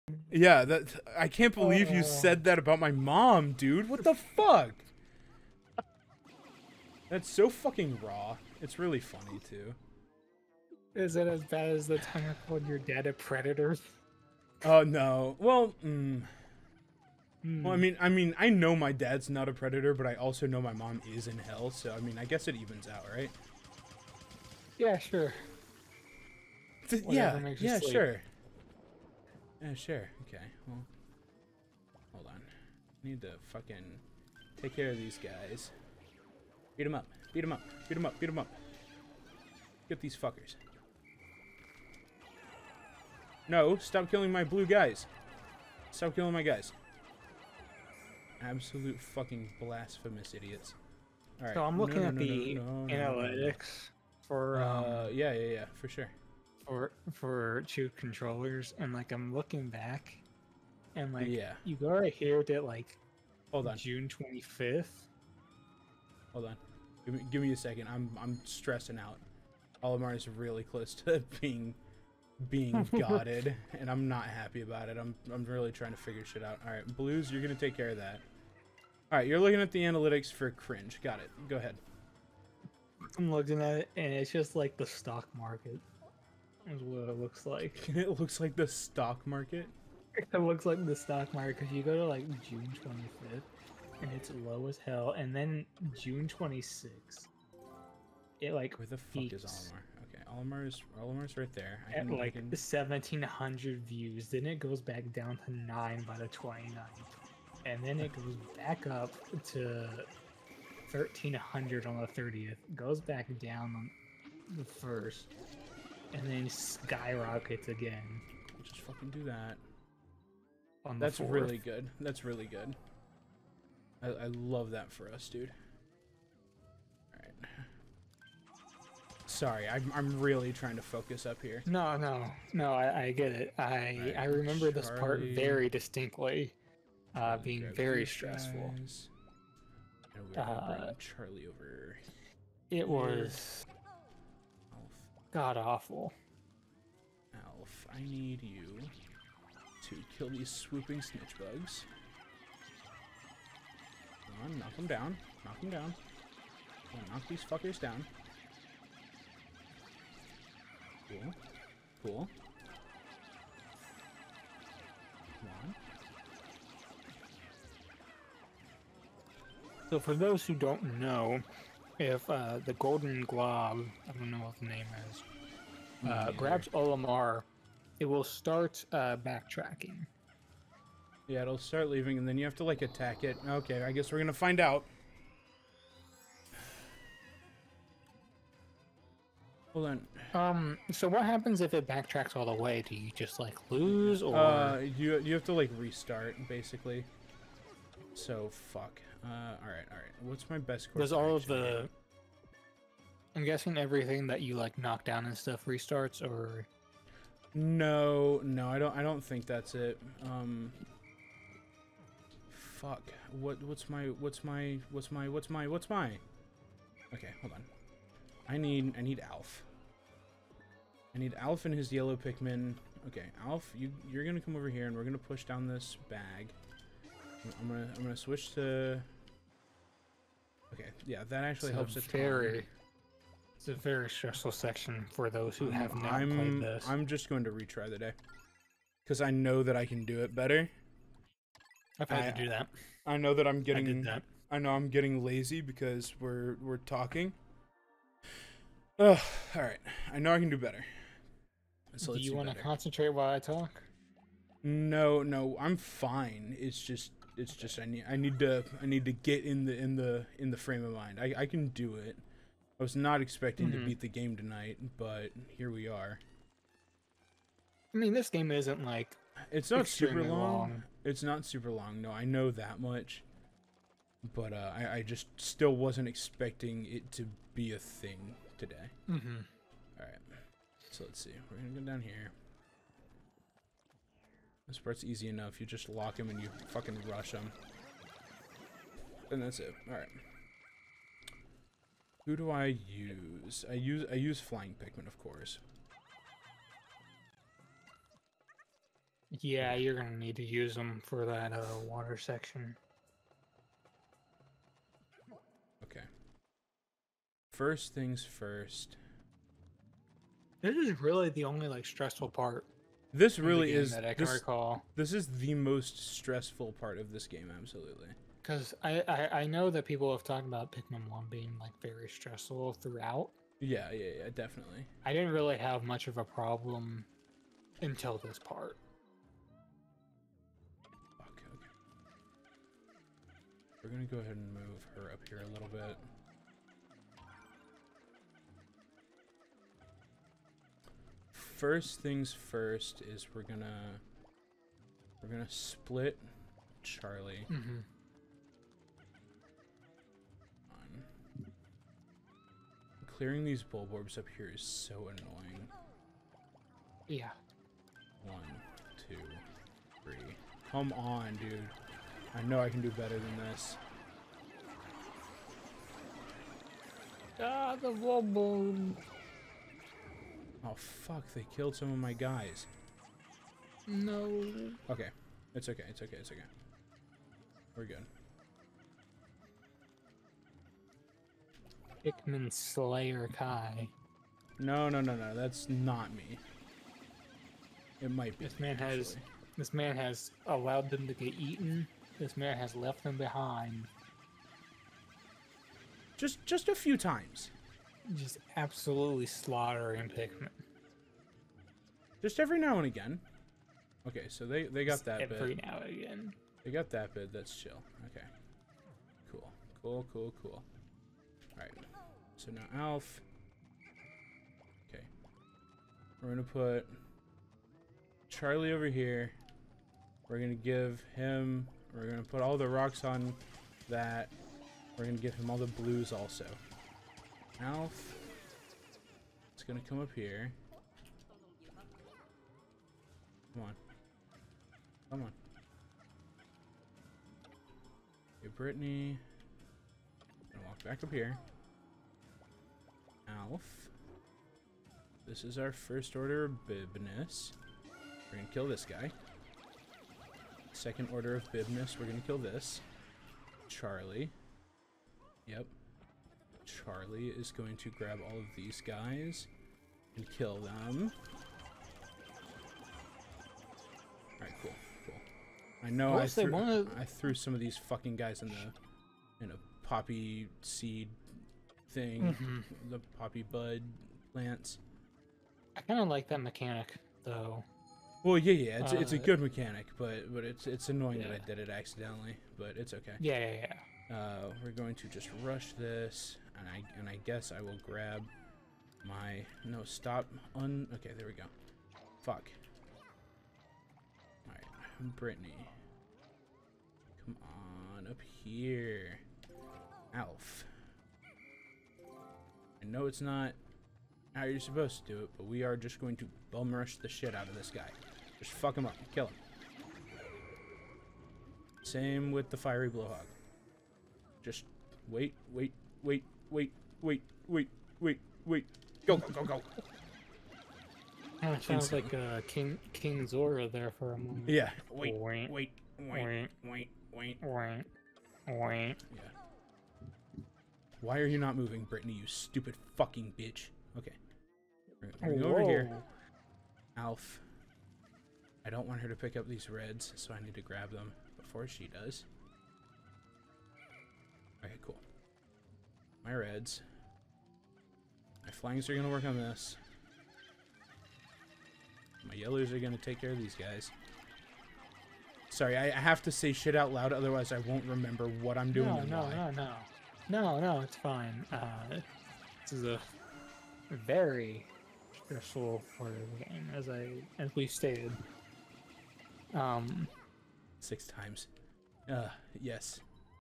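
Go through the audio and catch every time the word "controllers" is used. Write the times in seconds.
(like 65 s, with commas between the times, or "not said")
57 s.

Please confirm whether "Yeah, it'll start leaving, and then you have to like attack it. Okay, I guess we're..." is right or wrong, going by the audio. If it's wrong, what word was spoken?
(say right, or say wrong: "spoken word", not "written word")
right.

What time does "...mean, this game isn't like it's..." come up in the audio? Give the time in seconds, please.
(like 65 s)
267 s.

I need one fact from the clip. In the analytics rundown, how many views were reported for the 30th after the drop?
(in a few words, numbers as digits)
1,300.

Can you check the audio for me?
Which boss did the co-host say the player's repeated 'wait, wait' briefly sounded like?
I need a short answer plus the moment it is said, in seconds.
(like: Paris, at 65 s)
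King Zora, at 522 s.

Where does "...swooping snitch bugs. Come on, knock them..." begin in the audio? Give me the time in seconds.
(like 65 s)
150 s.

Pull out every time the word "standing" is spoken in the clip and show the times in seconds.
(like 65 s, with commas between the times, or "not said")
not said.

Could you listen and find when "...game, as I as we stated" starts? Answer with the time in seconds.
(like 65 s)
566 s.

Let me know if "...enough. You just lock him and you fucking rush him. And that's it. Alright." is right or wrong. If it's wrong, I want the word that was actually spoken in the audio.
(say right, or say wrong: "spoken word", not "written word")
right.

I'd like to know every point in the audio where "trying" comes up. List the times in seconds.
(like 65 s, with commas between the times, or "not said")
75 s, 130 s.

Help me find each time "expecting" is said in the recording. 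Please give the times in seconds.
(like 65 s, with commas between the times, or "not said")
263 s, 276 s.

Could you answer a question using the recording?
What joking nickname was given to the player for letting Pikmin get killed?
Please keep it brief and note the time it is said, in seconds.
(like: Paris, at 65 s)
Pikmin Slayer Kai, at 382 s.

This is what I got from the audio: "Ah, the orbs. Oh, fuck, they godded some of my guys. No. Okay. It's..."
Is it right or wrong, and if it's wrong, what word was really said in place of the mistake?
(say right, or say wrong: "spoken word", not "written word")
wrong: "killed", not "godded".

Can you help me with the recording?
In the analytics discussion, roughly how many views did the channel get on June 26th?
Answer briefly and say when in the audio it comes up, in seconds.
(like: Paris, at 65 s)
1,700, at 102 s.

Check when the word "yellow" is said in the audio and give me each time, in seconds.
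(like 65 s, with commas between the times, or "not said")
221 s, 552 s.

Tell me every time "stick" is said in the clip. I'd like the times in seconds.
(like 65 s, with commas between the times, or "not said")
not said.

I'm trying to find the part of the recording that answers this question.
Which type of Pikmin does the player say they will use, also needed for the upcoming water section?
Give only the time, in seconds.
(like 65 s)
294 s.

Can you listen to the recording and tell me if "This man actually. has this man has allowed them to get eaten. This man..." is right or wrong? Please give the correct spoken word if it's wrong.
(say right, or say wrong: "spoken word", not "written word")
right.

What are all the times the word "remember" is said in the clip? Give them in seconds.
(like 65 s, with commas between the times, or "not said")
134 s, 557 s.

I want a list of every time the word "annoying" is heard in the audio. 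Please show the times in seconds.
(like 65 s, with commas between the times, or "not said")
355 s, 480 s.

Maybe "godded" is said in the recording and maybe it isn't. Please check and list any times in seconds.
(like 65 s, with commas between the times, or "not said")
72 s.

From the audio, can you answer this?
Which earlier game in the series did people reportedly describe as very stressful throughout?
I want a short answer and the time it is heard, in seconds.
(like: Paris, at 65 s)
Pikmin One, at 320 s.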